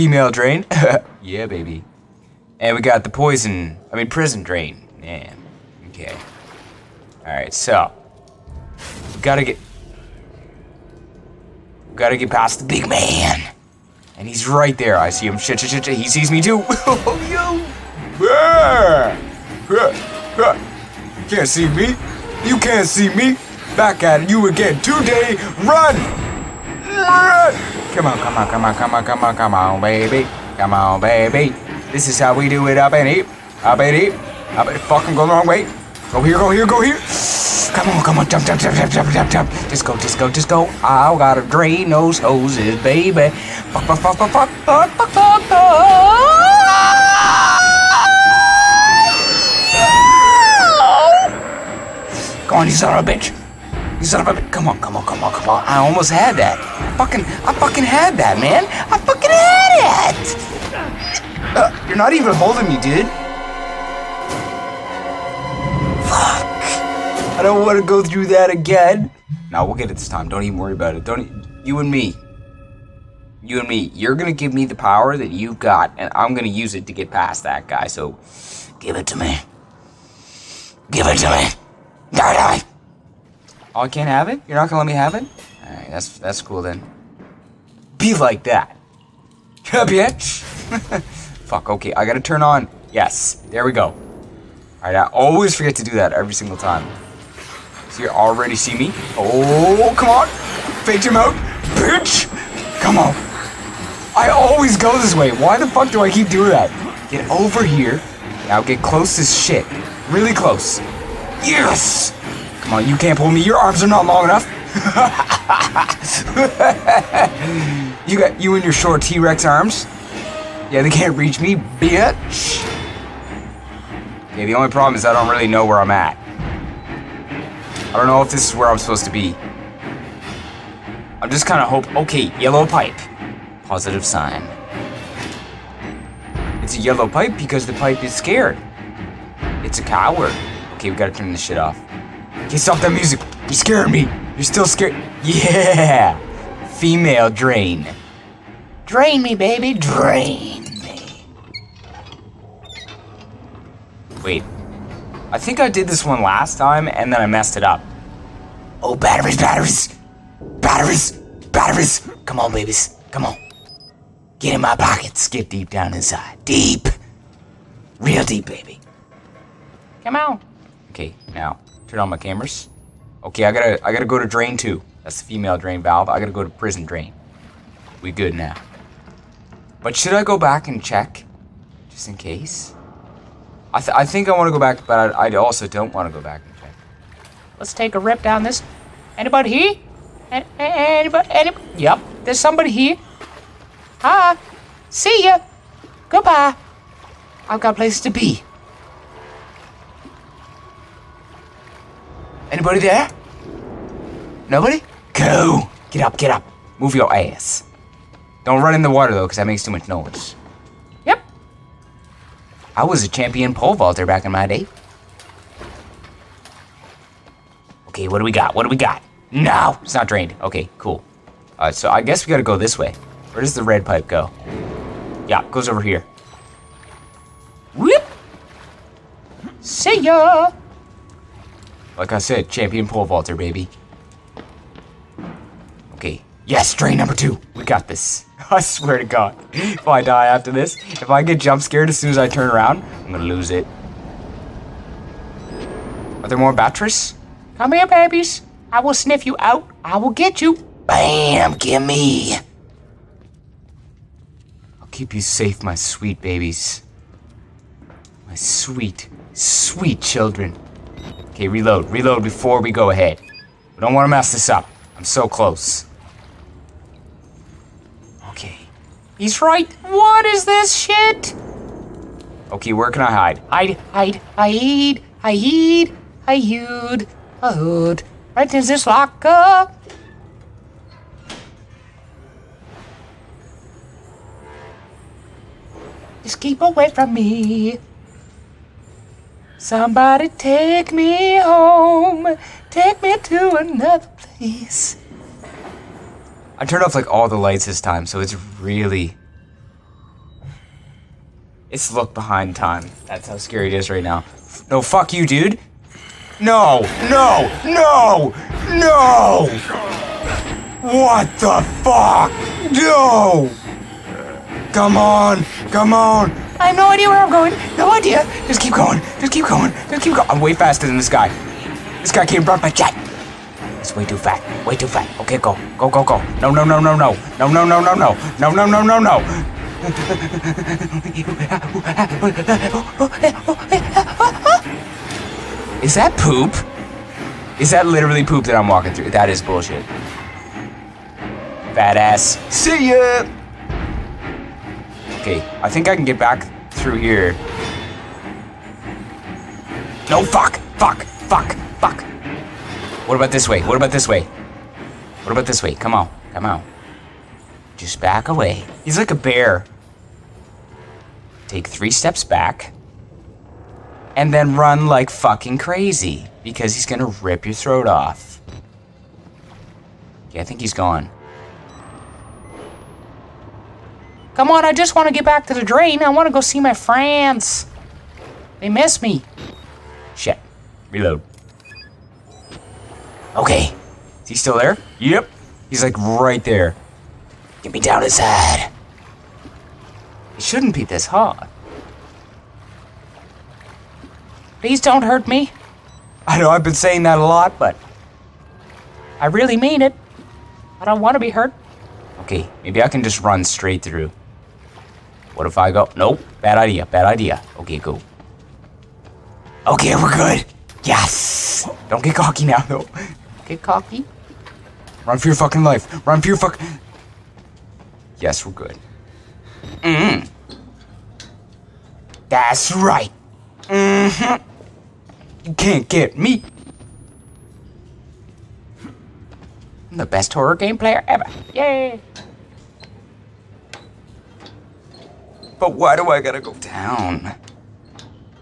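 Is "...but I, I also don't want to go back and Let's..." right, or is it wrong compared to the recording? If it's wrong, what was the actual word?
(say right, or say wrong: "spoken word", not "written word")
right.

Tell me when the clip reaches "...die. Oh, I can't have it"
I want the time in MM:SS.
01:22.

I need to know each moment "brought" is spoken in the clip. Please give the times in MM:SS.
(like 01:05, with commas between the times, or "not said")
05:22.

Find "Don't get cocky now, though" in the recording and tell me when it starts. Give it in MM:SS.
06:51.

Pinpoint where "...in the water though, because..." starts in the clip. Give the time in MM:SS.
03:28.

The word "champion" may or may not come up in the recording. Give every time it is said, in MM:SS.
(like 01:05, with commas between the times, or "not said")
03:33, 03:52.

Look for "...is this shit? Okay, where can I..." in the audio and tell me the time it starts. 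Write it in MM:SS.
04:30.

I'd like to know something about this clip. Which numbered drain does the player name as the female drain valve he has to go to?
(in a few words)
Drain two.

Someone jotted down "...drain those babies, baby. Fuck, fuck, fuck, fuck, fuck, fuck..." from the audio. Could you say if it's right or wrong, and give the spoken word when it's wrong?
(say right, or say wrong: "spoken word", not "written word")
wrong: "hoses", not "babies".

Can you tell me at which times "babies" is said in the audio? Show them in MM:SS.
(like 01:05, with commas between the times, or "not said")
02:42, 04:07, 04:16.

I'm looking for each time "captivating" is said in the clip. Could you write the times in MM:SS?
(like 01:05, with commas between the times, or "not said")
not said.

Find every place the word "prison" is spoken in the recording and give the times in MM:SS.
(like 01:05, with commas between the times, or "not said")
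00:04, 02:56.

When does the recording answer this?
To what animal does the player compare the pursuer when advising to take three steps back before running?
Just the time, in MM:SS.
05:59.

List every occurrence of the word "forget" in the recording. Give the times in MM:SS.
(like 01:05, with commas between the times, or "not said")
01:35.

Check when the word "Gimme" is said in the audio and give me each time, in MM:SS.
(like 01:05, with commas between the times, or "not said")
04:11.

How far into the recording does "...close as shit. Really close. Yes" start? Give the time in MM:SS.
01:48.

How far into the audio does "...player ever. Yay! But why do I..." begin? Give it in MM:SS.
07:10.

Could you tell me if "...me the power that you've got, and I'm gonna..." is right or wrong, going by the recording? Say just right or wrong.
right.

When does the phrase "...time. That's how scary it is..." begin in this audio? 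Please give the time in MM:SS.
05:02.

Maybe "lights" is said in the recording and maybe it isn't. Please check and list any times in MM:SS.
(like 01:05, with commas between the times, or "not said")
04:57.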